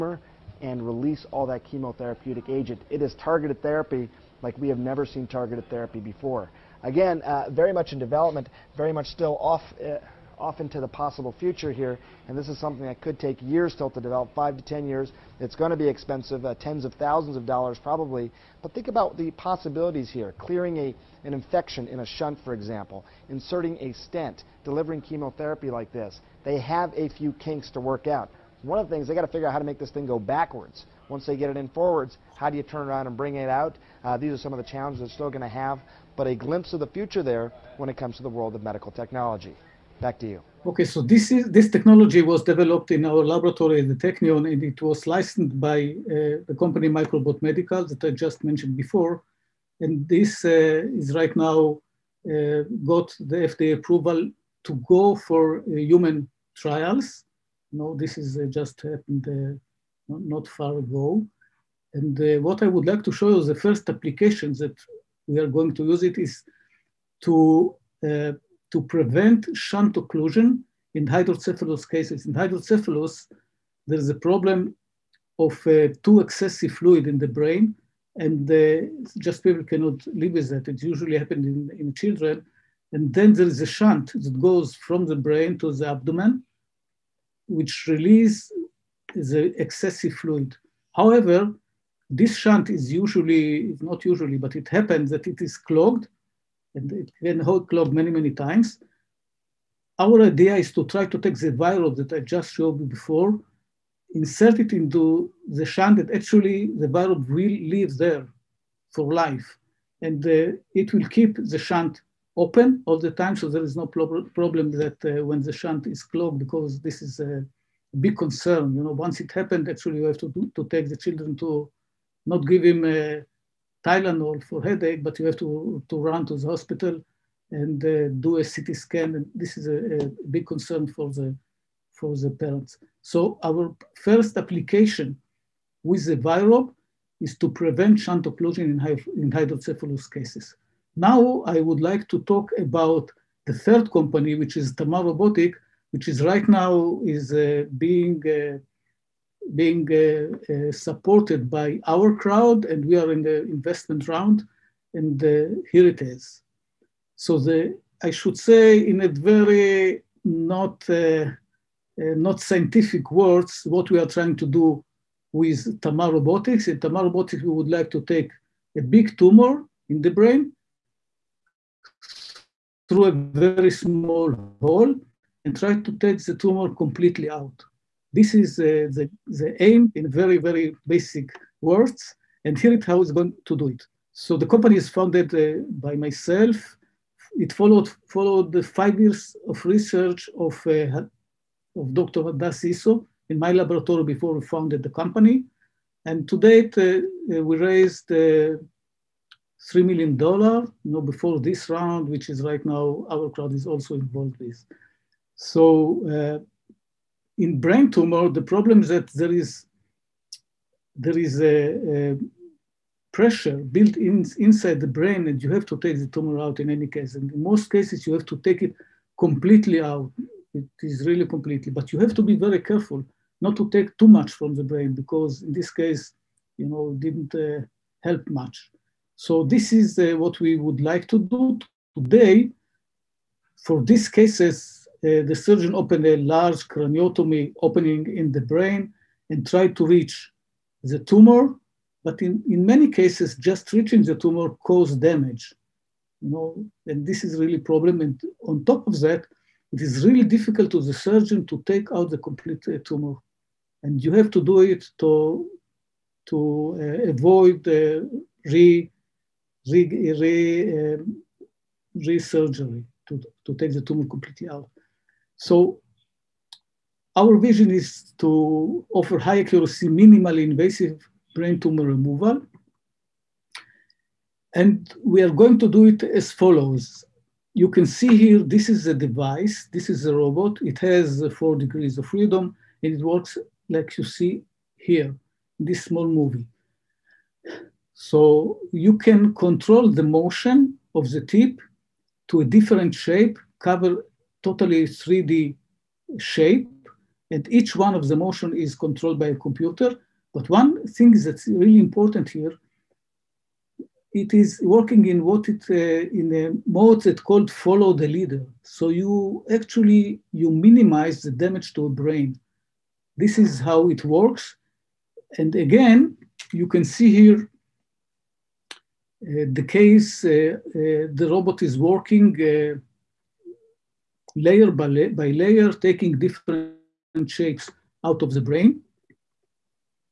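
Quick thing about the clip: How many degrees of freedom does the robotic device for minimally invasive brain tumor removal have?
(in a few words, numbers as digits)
4.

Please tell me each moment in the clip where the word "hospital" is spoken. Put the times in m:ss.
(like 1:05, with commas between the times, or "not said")
2:06.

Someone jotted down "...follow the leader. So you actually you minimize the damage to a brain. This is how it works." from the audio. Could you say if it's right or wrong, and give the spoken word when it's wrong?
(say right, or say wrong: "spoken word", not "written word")
right.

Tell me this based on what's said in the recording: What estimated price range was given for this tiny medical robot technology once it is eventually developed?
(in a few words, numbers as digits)
tens of thousands of dollars.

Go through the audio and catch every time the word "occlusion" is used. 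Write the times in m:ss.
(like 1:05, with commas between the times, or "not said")
1:09, 2:18.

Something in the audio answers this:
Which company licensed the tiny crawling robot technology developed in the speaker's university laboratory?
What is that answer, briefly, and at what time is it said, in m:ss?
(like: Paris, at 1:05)
Microbot Medical, at 0:46.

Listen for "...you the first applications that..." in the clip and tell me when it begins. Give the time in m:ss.
1:03.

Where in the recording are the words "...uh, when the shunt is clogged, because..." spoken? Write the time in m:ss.
1:55.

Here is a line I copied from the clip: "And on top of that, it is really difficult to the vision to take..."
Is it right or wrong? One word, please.
wrong.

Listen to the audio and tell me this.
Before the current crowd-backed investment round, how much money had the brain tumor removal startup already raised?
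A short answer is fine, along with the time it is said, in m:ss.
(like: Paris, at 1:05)
$3 million, at 3:19.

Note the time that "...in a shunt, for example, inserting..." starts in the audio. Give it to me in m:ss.
0:21.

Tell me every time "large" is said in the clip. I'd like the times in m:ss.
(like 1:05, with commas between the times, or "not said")
3:56.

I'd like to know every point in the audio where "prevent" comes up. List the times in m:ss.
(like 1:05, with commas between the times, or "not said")
1:08, 2:17.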